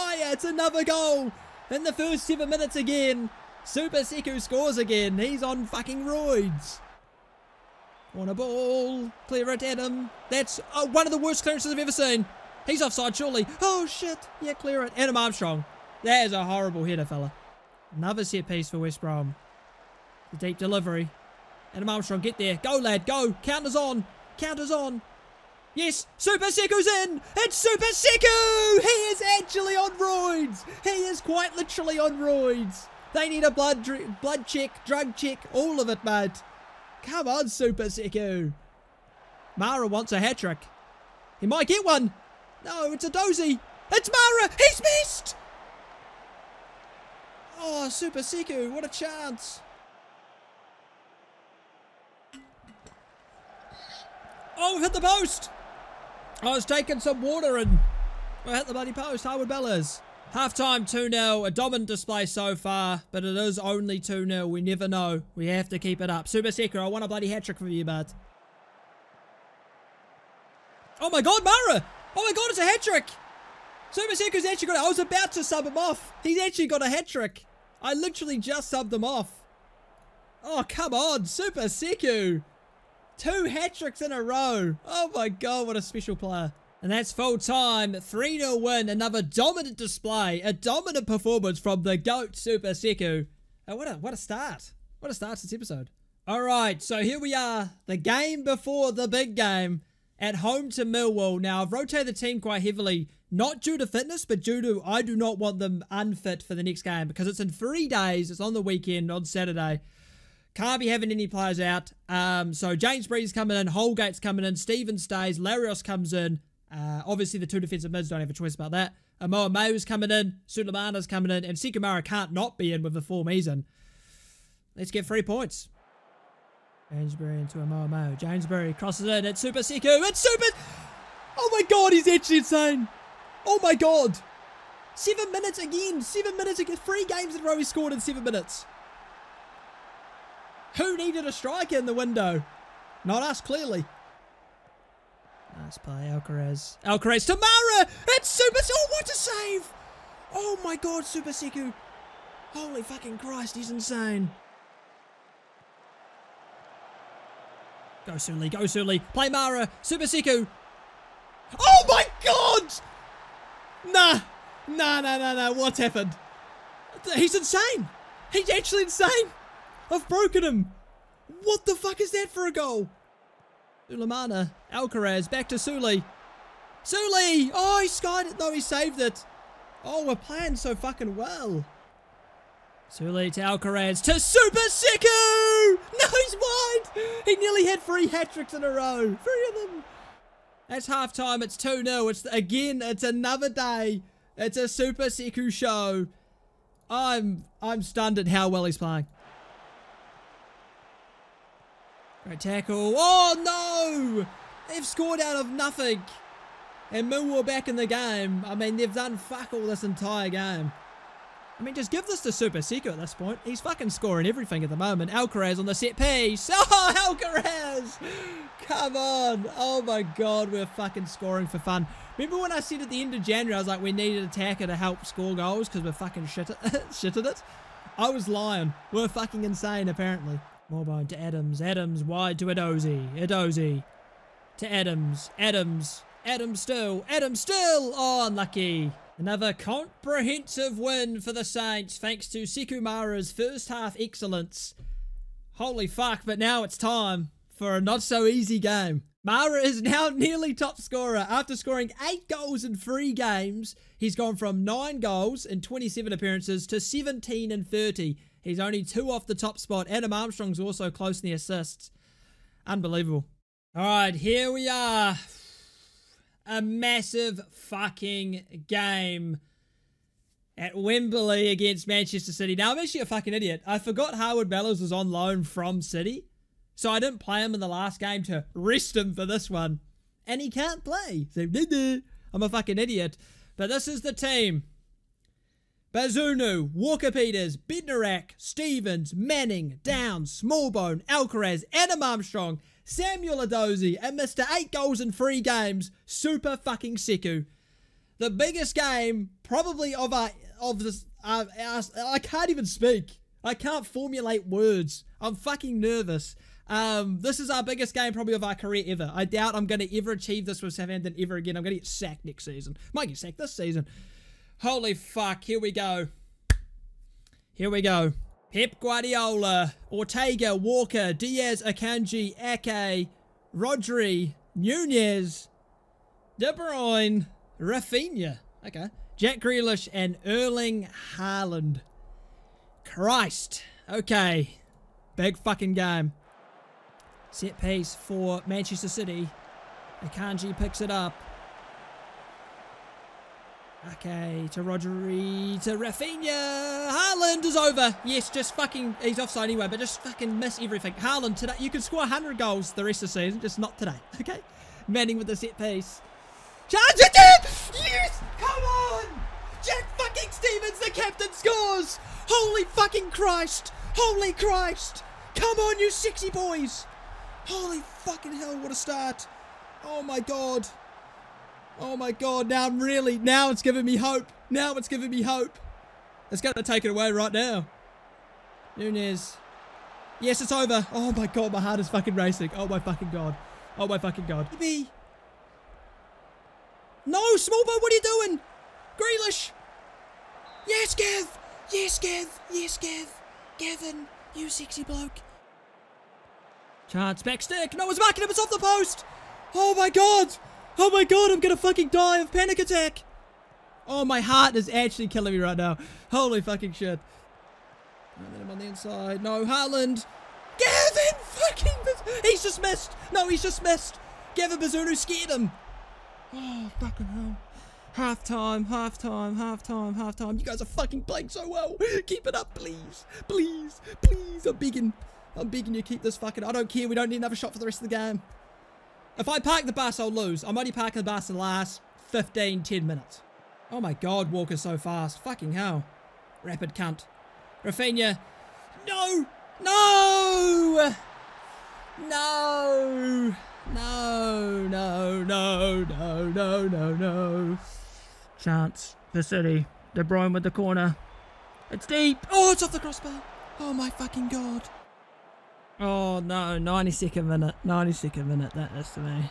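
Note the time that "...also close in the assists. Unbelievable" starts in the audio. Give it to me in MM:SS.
04:20.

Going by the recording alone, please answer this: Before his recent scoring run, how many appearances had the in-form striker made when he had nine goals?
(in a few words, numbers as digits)
27.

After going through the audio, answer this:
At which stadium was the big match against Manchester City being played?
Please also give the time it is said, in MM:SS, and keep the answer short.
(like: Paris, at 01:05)
Wembley, at 04:30.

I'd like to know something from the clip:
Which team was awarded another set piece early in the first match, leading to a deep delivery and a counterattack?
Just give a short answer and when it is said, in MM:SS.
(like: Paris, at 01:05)
West Brom, at 00:18.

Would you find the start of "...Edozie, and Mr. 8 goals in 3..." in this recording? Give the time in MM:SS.
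04:53.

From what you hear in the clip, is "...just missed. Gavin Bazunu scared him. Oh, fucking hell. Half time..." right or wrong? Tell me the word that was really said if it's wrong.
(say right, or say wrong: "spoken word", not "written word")
right.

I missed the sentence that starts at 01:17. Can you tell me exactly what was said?
I literally just subbed him off.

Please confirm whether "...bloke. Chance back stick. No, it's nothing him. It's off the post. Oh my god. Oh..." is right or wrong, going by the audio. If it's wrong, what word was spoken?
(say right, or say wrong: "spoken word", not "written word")
wrong: "marking", not "nothing".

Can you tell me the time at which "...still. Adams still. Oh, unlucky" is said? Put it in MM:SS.
03:56.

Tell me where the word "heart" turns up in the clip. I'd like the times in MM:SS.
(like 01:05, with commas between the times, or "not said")
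06:21, 06:44.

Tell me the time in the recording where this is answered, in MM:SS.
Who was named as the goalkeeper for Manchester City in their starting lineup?
05:19.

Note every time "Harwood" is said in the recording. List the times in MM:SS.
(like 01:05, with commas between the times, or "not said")
00:59, 04:34.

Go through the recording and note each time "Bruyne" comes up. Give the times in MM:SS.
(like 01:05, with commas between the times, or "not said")
05:26, 07:30.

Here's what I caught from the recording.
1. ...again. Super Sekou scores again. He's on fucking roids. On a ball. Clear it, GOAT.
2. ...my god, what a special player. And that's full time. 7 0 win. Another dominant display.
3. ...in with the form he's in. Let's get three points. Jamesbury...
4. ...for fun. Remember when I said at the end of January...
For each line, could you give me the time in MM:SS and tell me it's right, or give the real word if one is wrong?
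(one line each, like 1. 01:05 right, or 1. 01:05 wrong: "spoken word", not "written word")
1. 00:02 wrong: "Adam", not "GOAT"
2. 01:25 wrong: "3", not "7"
3. 02:02 right
4. 03:41 right.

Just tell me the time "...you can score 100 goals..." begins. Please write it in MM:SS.
05:51.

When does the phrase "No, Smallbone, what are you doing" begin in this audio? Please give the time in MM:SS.
06:27.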